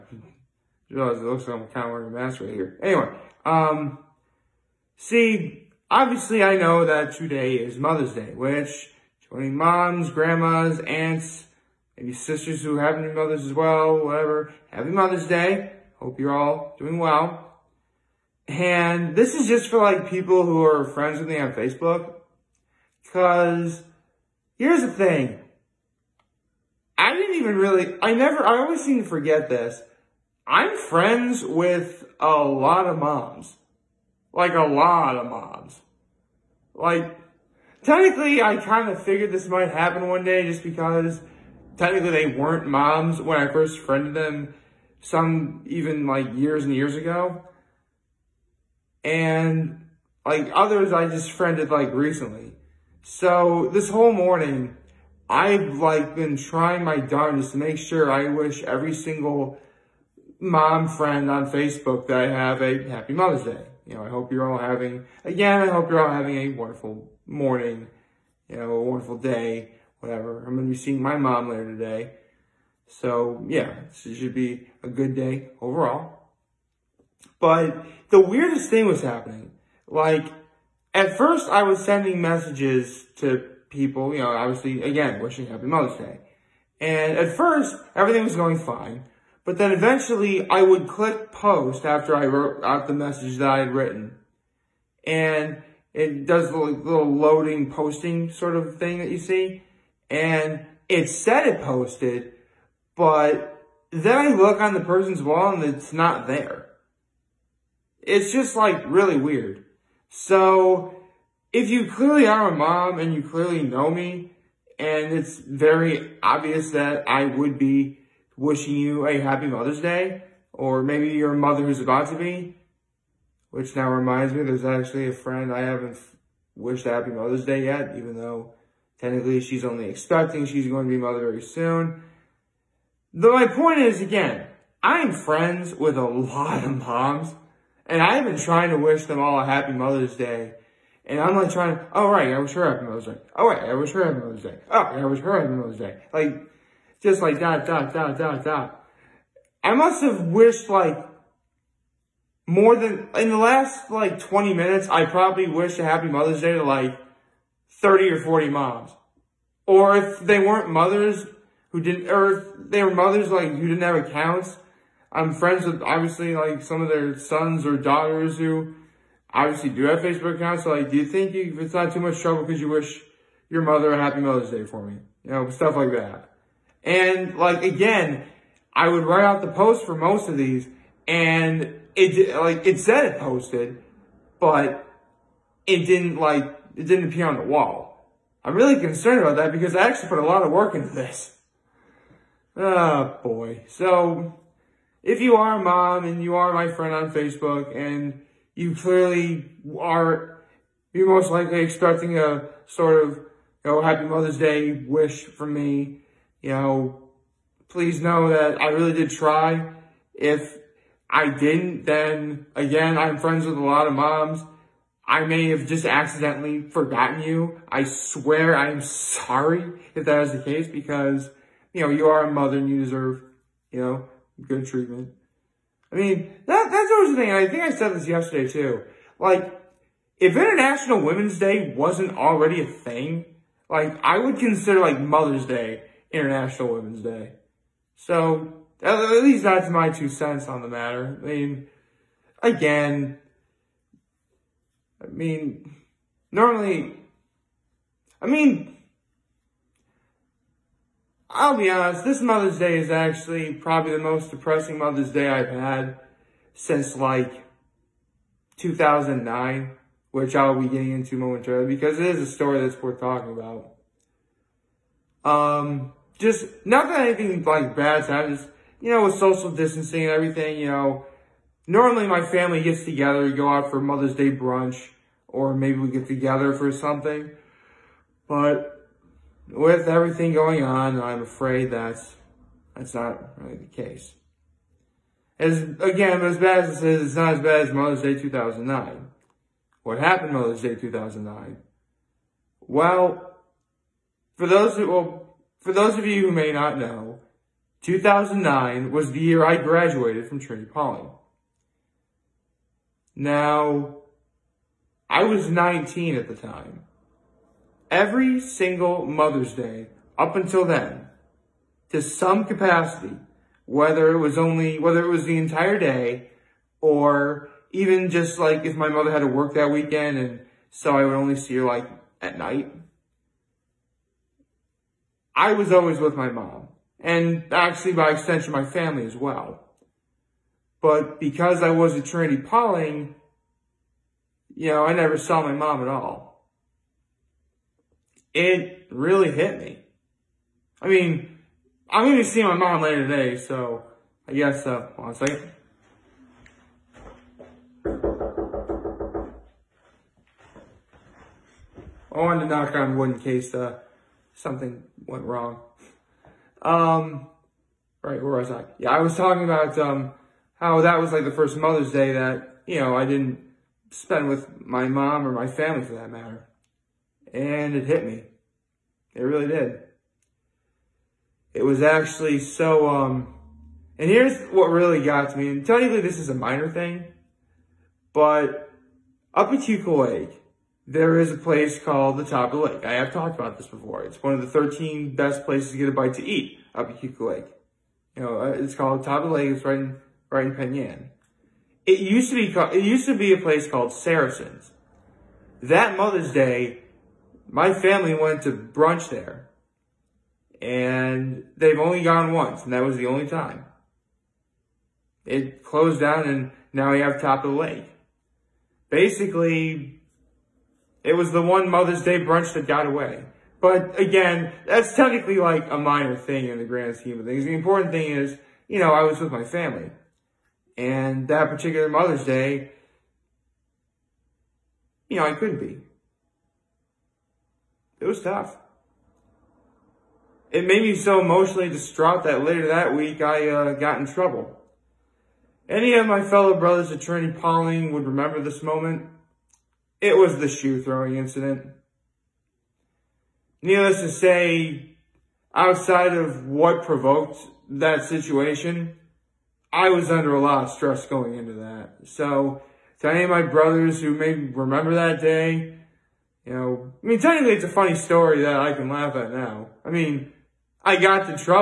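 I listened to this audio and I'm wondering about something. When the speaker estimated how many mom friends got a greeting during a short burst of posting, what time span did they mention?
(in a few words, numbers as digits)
20 minutes.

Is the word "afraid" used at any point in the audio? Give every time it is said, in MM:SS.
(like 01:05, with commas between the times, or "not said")
04:41.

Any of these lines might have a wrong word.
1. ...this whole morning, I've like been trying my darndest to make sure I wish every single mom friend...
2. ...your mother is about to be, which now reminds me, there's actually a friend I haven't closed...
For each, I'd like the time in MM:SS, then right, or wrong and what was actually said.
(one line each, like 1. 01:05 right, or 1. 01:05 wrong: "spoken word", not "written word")
1. 00:53 right
2. 02:01 wrong: "wished", not "closed".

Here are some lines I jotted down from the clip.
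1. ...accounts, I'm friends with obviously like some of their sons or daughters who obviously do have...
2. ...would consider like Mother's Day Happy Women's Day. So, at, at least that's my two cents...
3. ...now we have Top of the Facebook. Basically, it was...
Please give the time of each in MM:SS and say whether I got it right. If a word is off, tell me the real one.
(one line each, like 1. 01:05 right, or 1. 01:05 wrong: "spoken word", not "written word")
1. 02:44 right
2. 03:54 wrong: "International", not "Happy"
3. 06:46 wrong: "Lake", not "Facebook".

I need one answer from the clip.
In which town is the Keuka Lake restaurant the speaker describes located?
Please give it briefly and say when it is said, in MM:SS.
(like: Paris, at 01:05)
Penn Yan, at 06:30.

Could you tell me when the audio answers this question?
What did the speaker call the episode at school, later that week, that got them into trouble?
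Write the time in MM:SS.
07:20.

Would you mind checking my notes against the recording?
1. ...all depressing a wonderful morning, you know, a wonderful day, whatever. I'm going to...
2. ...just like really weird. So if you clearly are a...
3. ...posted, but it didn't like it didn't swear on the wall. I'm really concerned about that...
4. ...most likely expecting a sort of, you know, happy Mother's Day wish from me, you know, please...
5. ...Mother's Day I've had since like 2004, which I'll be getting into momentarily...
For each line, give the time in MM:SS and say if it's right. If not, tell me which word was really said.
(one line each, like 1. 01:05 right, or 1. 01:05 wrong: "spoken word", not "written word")
1. 01:06 wrong: "having", not "depressing"
2. 01:48 right
3. 03:03 wrong: "appear", not "swear"
4. 03:21 right
5. 04:14 wrong: "2009", not "2004".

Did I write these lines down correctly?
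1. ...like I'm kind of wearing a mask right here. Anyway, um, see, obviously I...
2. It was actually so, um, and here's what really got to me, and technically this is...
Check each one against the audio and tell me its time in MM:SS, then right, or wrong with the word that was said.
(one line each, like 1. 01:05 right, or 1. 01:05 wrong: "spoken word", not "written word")
1. 00:01 right
2. 06:11 right.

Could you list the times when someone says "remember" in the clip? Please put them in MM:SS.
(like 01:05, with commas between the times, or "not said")
07:18, 07:34.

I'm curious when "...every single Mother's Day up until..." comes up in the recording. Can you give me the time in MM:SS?
05:07.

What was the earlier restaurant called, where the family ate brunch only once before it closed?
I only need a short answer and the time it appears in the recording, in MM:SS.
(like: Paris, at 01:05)
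Saracens, at 06:33.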